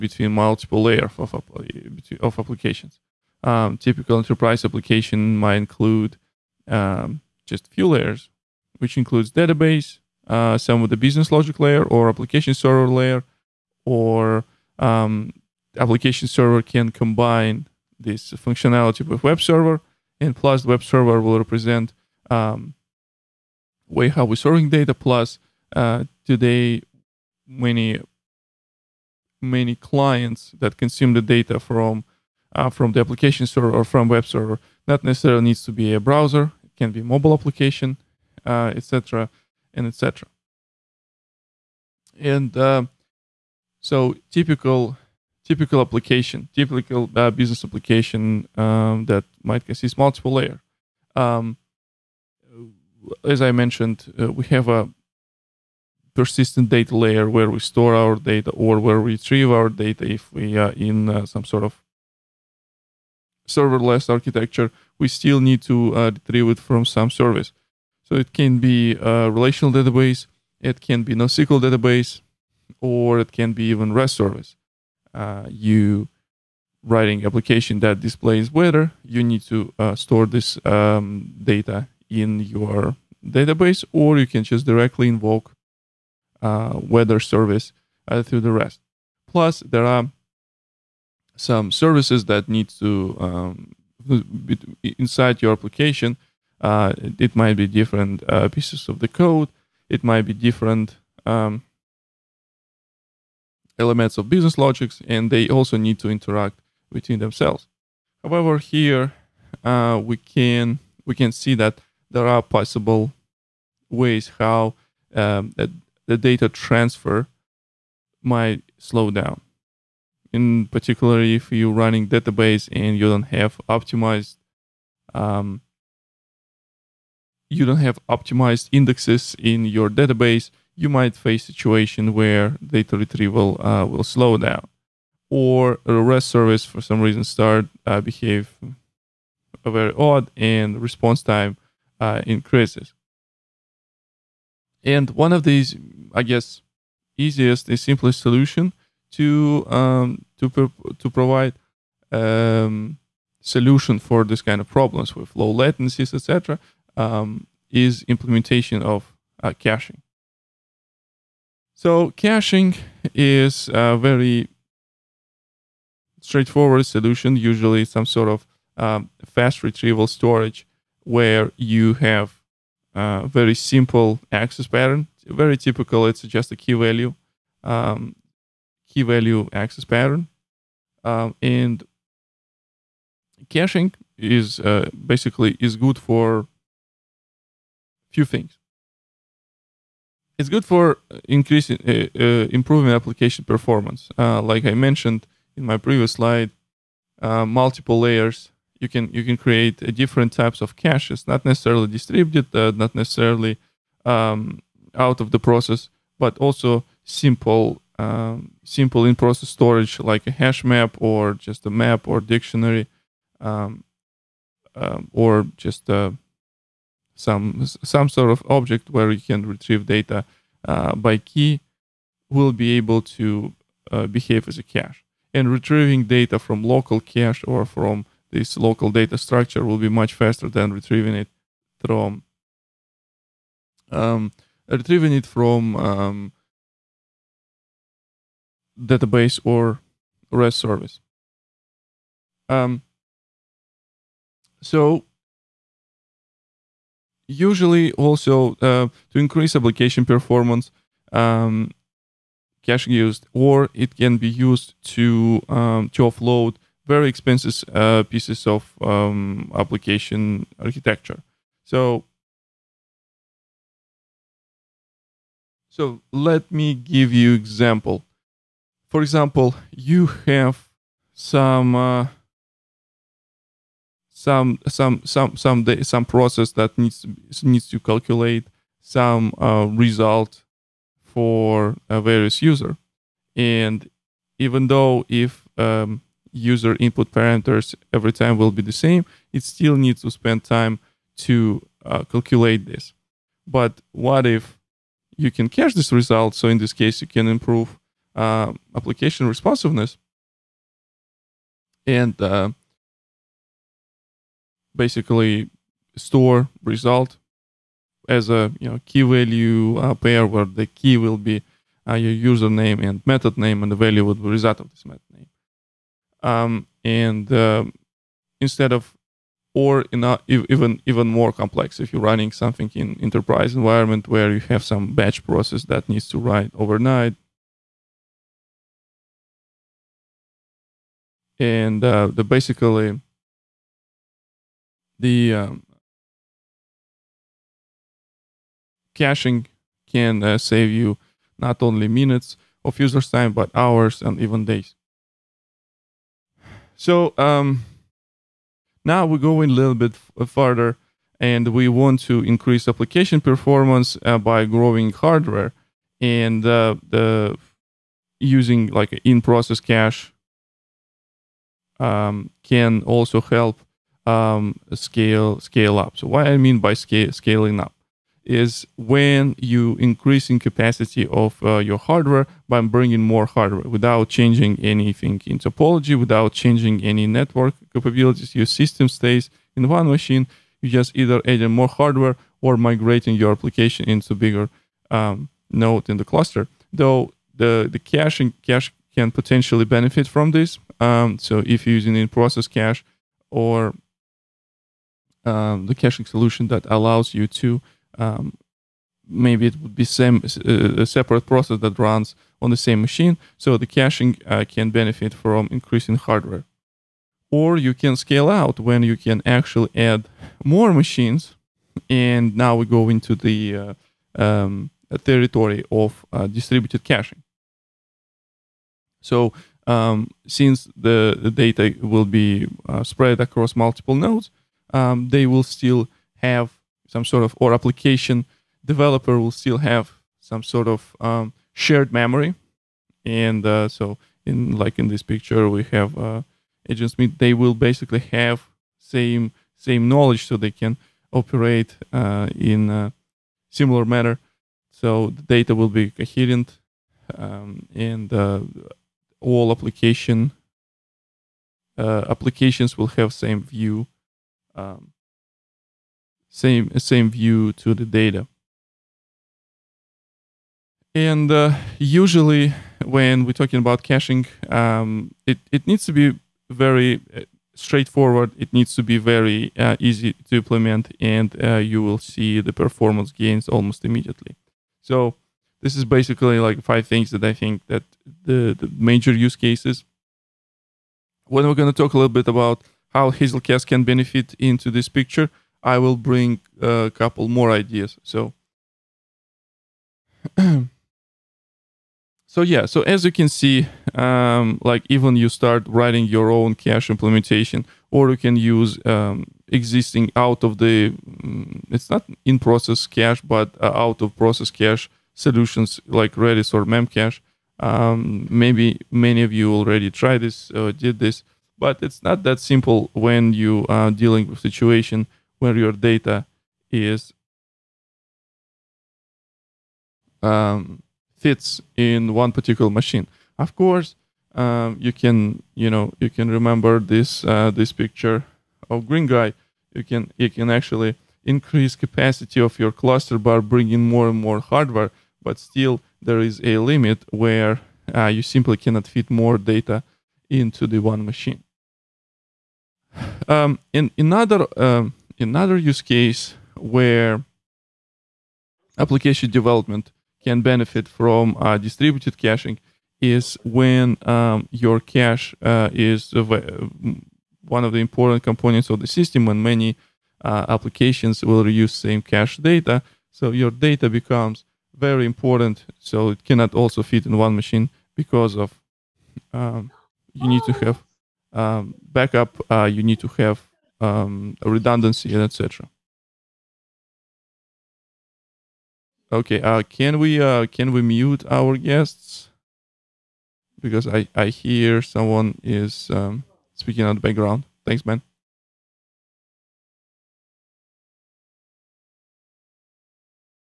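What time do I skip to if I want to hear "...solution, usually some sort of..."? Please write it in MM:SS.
02:46.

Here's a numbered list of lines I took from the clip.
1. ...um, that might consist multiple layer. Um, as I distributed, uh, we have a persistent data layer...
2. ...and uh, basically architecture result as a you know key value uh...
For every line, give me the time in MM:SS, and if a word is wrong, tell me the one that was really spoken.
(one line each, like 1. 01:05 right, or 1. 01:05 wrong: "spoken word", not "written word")
1. 00:48 wrong: "mentioned", not "distributed"
2. 05:01 wrong: "store", not "architecture".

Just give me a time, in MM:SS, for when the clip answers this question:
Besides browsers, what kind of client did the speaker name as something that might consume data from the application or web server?
00:37.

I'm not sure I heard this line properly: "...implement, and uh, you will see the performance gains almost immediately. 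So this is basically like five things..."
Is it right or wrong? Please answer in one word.
right.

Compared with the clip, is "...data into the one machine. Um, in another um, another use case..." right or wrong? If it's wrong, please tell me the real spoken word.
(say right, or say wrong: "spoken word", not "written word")
right.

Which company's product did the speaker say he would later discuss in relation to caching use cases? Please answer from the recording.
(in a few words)
Hazelcast.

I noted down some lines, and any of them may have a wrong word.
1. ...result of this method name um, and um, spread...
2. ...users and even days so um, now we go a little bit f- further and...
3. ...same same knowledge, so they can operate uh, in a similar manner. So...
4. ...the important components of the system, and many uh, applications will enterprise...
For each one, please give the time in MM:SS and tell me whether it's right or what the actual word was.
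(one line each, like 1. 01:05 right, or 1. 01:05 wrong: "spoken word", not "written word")
1. 05:14 wrong: "instead", not "spread"
2. 05:43 wrong: "hours", not "users"
3. 07:18 right
4. 09:17 wrong: "reuse", not "enterprise".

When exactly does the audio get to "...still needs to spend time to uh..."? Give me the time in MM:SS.
04:49.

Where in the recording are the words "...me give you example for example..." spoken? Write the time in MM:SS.
04:26.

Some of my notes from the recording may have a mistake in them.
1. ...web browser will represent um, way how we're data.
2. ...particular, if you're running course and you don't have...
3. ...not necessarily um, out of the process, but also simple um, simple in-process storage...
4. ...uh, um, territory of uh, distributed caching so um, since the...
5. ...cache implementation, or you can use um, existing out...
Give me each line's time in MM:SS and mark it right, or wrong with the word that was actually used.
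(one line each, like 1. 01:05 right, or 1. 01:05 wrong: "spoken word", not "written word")
1. 00:20 wrong: "server", not "browser"
2. 02:00 wrong: "database", not "course"
3. 03:22 right
4. 06:53 right
5. 08:16 right.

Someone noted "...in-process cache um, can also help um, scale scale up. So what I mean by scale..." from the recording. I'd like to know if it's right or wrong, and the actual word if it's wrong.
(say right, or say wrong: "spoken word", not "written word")
right.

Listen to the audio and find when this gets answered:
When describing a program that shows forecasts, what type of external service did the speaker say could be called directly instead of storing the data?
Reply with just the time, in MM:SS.
01:26.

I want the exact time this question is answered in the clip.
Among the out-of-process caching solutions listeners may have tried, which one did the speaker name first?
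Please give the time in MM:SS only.
08:26.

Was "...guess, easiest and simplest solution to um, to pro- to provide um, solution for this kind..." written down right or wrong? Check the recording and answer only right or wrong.
right.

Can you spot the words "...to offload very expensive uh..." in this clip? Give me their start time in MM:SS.
04:15.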